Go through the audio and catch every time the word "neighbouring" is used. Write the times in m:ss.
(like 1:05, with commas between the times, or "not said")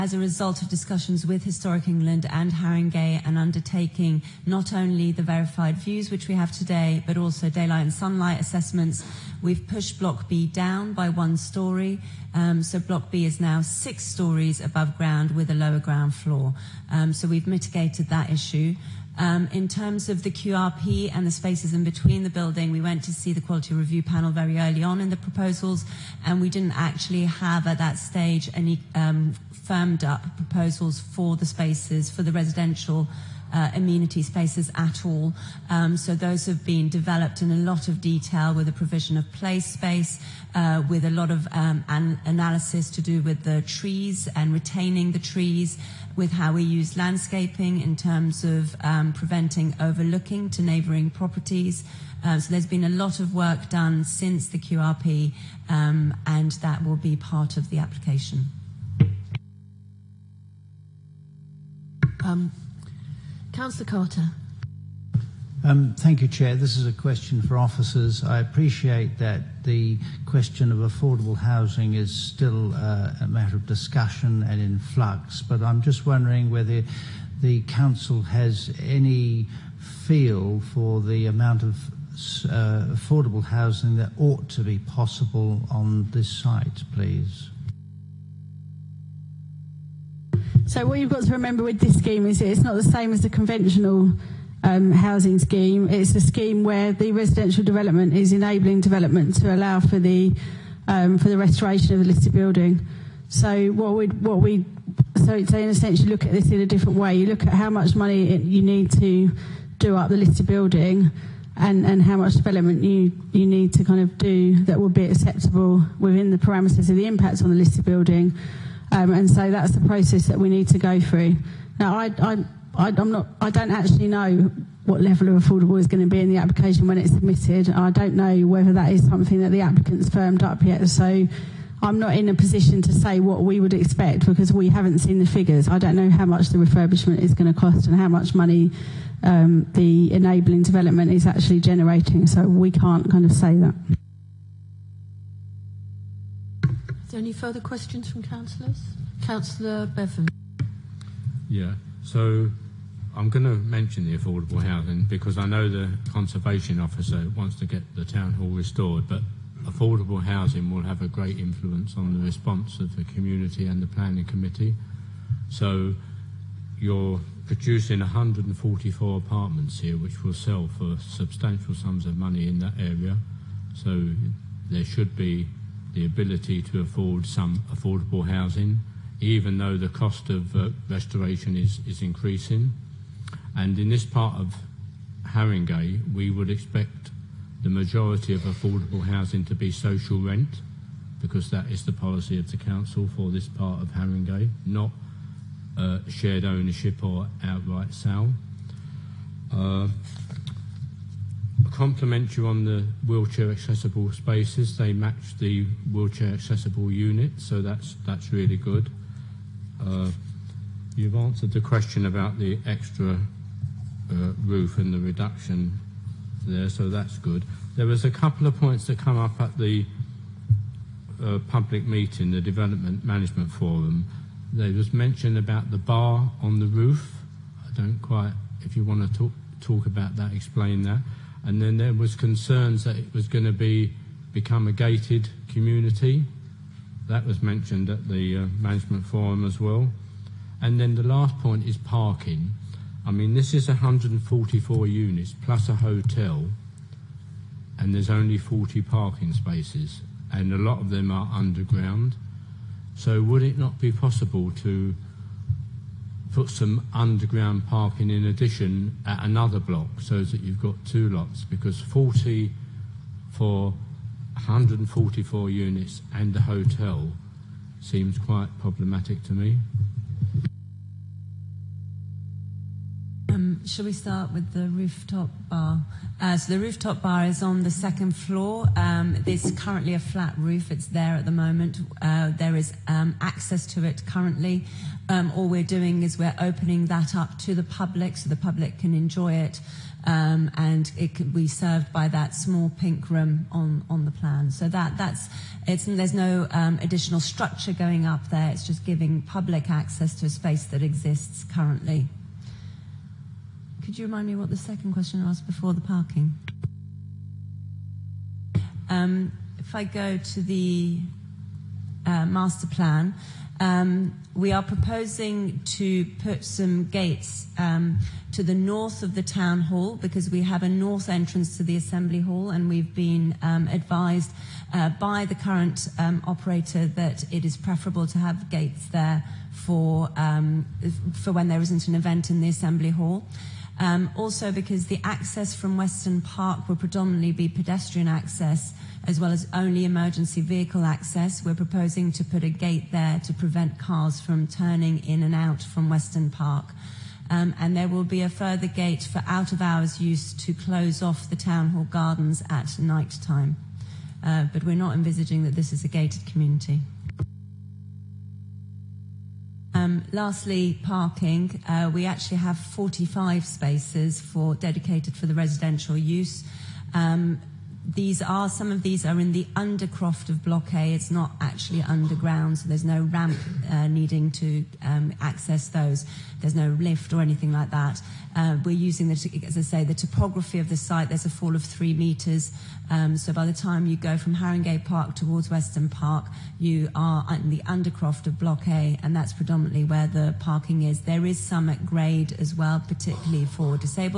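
0:50.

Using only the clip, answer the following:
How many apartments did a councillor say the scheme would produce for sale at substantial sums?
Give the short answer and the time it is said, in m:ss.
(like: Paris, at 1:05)
144, at 2:47.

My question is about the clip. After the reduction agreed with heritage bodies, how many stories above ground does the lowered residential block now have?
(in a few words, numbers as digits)
6.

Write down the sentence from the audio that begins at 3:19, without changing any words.
Uh, compliment you on the wheelchair accessible spaces.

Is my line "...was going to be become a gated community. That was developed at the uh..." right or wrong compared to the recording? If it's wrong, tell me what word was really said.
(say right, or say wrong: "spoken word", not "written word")
wrong: "mentioned", not "developed".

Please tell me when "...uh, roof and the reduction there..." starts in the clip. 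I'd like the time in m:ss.
3:34.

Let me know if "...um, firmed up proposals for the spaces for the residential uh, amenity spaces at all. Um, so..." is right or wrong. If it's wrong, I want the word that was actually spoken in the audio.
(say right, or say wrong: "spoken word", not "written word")
right.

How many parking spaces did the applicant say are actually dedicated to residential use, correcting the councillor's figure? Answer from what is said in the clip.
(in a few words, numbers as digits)
45.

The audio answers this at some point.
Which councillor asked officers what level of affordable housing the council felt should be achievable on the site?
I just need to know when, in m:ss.
1:03.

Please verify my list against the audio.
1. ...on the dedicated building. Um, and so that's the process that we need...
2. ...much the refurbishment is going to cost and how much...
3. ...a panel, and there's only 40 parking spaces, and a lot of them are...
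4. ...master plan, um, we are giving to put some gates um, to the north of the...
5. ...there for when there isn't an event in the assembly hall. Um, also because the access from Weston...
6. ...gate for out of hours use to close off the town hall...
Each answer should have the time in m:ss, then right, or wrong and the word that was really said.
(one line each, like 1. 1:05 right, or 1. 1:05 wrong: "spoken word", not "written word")
1. 1:57 wrong: "listed", not "dedicated"
2. 2:16 right
3. 4:05 wrong: "hotel", not "panel"
4. 5:12 wrong: "proposing", not "giving"
5. 5:28 right
6. 5:48 right.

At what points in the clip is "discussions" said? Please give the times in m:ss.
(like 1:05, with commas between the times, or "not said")
0:00, 1:13.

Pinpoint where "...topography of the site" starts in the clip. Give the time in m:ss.
6:19.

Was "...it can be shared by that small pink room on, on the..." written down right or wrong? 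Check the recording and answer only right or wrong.
wrong.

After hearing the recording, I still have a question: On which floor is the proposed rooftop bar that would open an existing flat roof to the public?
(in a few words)
Second floor.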